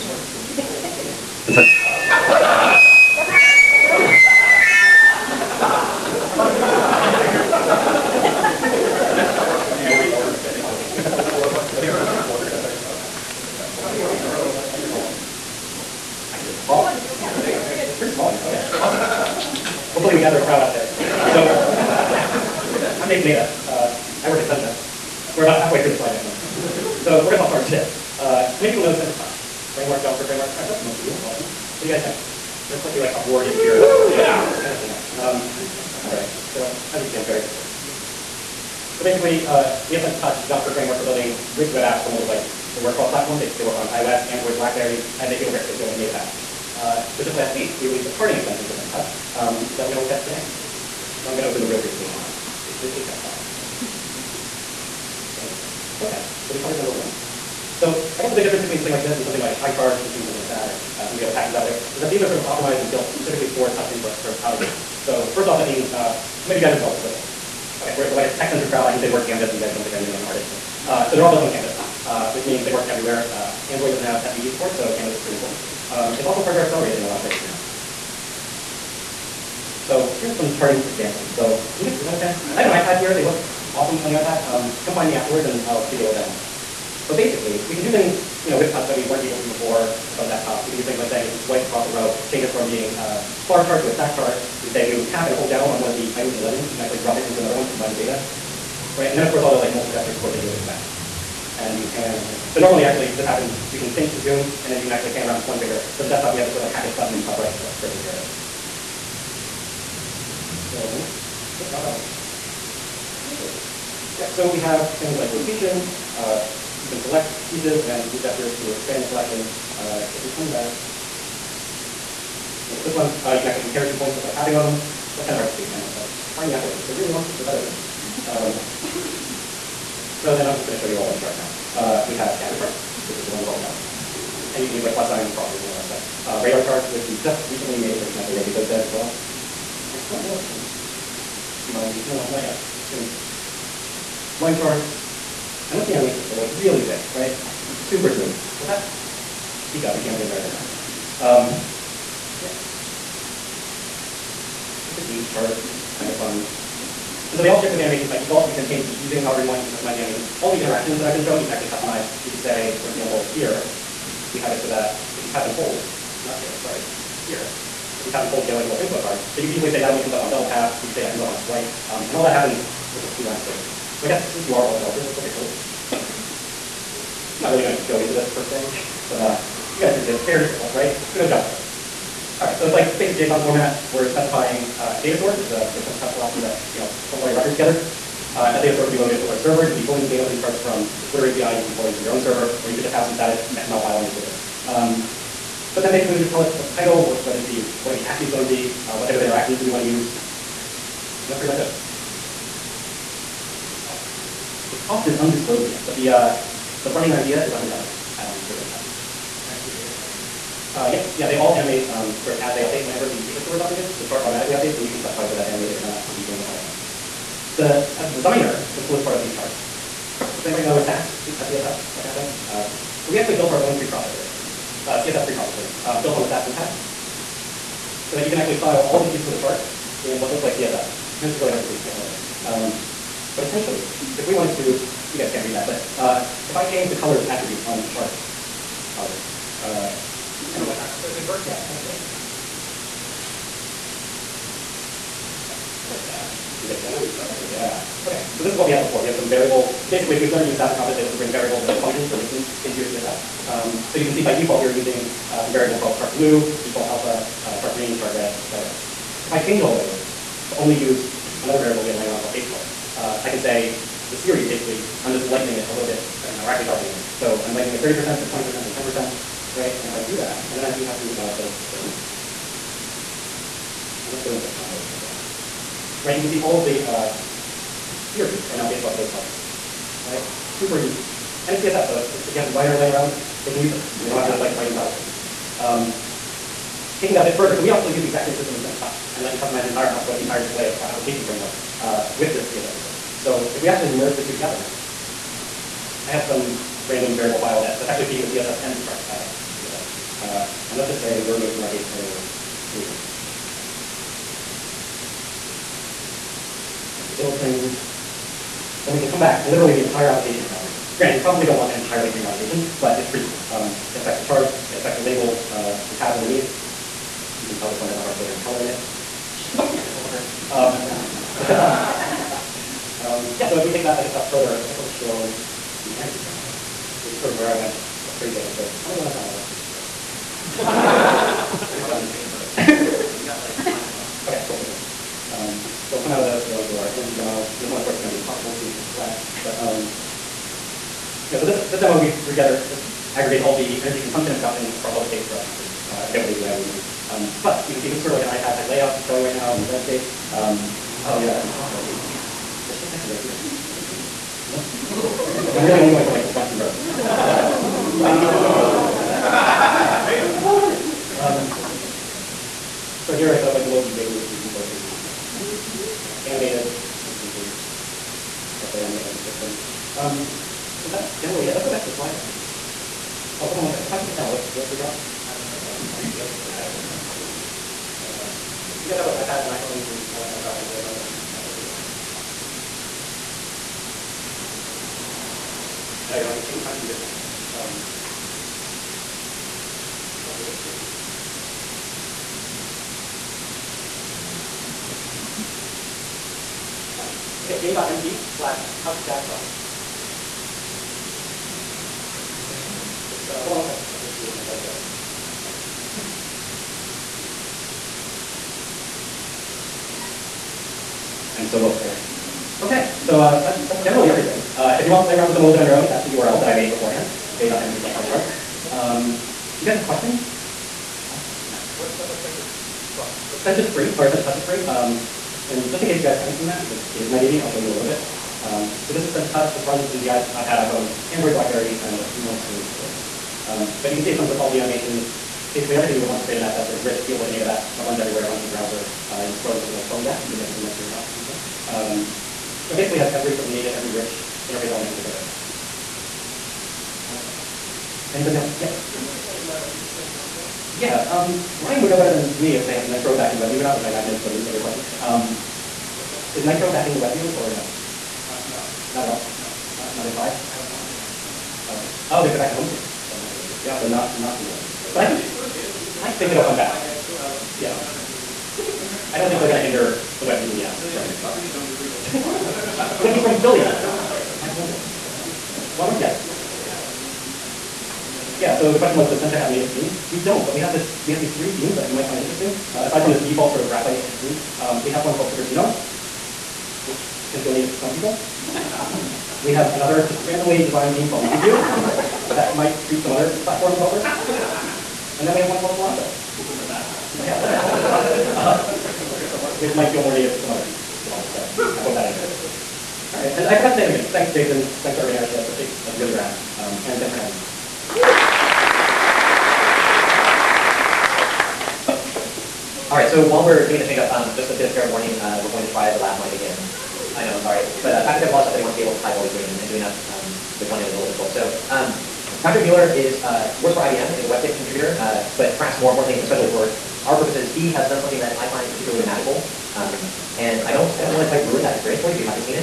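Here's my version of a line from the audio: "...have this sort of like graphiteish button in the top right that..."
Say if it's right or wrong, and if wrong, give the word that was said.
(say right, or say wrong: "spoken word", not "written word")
wrong: "hackish", not "graphiteish".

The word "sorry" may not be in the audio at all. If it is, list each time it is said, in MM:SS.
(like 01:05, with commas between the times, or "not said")
02:46, 08:37.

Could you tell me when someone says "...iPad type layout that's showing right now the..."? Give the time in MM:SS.
05:48.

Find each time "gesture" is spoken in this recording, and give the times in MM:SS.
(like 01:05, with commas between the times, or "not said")
01:39, 01:58.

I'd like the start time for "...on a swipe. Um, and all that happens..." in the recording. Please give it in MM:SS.
02:51.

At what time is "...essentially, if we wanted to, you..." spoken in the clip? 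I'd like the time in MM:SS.
03:53.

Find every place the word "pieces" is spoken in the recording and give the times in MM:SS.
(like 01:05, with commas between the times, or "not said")
01:57, 03:49.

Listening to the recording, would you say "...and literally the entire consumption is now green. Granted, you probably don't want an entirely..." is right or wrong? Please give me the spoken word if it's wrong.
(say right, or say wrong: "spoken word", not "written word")
wrong: "application", not "consumption".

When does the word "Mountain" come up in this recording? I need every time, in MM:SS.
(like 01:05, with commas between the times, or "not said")
08:11.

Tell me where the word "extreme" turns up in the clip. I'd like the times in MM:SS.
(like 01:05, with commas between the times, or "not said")
not said.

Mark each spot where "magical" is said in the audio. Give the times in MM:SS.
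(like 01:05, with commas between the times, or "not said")
08:49.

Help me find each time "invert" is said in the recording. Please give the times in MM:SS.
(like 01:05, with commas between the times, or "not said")
04:01.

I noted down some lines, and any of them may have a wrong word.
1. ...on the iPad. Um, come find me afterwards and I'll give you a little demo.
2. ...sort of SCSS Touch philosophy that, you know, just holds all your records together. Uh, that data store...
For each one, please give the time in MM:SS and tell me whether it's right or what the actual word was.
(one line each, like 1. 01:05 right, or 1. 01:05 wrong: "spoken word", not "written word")
1. 01:24 right
2. 03:05 wrong: "Sencha", not "SCSS".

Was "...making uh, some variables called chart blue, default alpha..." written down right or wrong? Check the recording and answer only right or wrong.
wrong.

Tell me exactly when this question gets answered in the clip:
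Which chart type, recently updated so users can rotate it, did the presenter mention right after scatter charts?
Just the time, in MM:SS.
02:16.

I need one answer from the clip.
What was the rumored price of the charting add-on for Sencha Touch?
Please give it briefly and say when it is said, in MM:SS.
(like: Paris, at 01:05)
$100, at 03:27.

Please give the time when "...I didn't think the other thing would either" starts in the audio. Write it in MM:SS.
06:15.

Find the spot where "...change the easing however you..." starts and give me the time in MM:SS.
02:38.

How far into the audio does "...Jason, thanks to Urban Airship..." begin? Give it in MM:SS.
08:24.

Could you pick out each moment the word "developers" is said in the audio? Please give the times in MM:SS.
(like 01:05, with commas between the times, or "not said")
02:54, 05:19, 08:13, 08:21.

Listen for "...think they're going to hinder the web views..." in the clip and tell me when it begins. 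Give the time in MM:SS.
07:49.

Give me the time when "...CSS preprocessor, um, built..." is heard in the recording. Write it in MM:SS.
03:45.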